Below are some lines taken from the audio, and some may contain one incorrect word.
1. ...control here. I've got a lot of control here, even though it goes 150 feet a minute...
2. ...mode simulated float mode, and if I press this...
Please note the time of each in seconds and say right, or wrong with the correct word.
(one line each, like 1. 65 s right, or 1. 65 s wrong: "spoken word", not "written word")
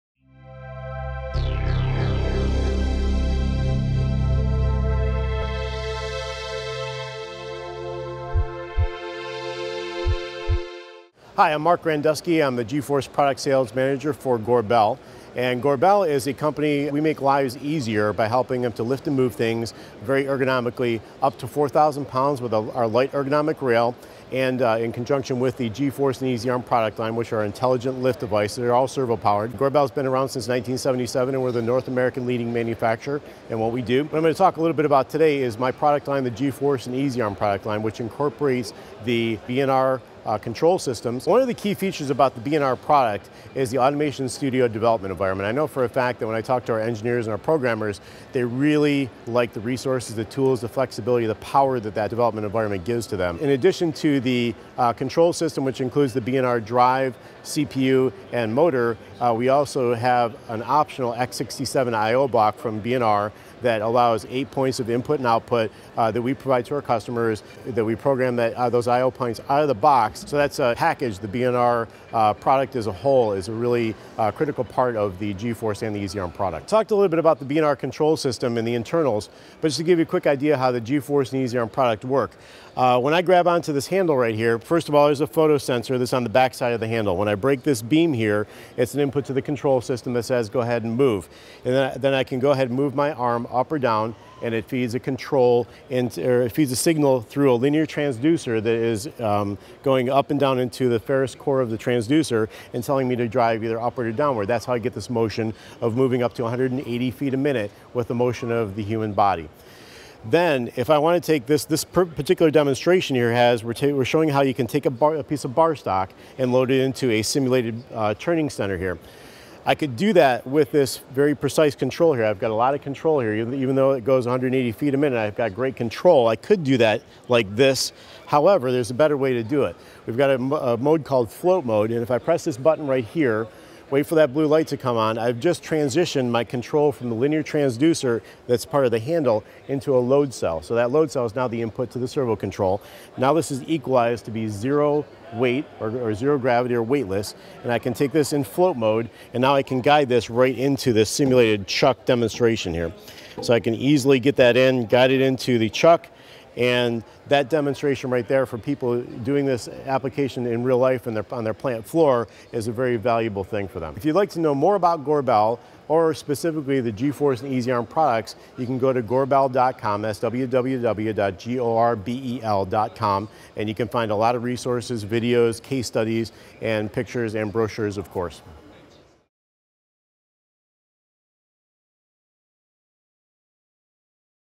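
1. 121 s wrong: "180", not "150"
2. 130 s wrong: "called", not "simulated".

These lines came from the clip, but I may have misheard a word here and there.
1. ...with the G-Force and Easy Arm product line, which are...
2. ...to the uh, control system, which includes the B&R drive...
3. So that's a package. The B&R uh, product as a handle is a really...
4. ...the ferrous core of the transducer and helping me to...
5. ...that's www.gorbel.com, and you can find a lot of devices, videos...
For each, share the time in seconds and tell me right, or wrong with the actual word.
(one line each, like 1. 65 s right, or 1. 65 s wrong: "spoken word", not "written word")
1. 25 s right
2. 53 s right
3. 70 s wrong: "whole", not "handle"
4. 100 s wrong: "telling", not "helping"
5. 170 s wrong: "resources", not "devices".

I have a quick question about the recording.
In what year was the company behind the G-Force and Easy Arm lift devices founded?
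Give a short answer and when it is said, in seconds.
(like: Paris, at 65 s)
1977, at 30 s.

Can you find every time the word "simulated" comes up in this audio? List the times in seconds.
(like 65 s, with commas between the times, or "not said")
117 s, 151 s.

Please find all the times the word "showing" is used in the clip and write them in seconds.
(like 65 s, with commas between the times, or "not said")
114 s.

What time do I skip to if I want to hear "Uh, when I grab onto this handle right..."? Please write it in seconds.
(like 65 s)
82 s.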